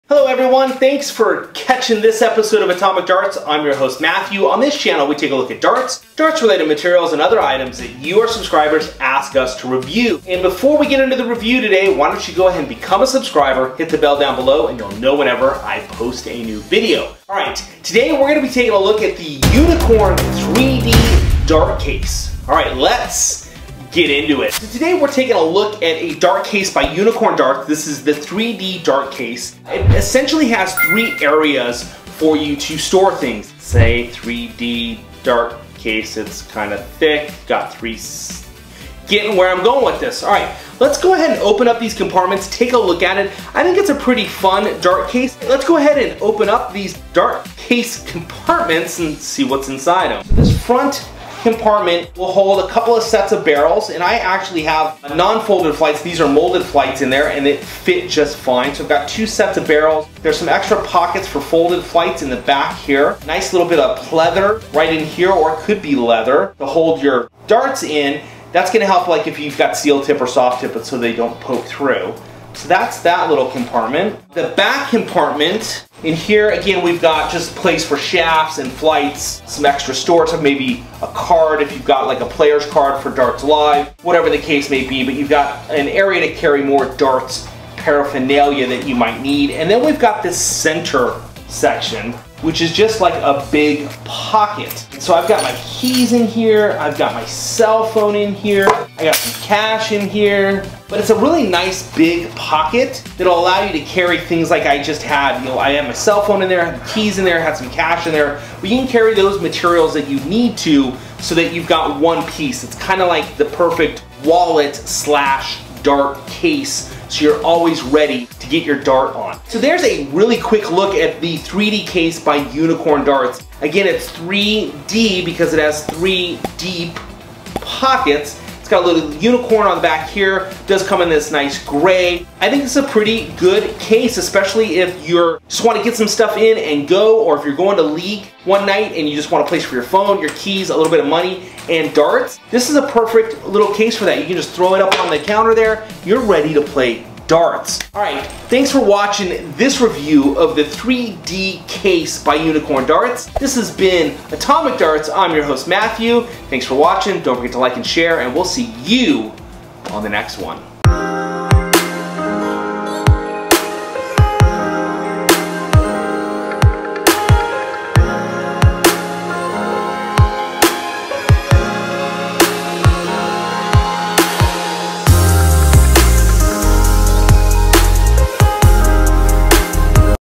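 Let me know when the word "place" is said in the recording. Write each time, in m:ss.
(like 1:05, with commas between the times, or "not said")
1:17, 2:19.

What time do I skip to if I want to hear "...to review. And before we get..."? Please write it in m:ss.
0:09.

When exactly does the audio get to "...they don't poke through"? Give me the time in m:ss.
1:10.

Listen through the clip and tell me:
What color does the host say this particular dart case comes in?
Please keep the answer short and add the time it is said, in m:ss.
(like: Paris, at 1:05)
Gray, at 2:11.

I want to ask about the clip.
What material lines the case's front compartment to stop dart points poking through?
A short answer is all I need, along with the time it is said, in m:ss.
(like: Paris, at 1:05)
Pleather, at 1:03.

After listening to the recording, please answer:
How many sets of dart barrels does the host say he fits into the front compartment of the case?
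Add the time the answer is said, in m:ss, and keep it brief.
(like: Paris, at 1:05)
2, at 0:59.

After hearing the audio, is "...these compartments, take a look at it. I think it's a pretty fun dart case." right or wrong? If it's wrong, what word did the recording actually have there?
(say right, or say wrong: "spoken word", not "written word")
right.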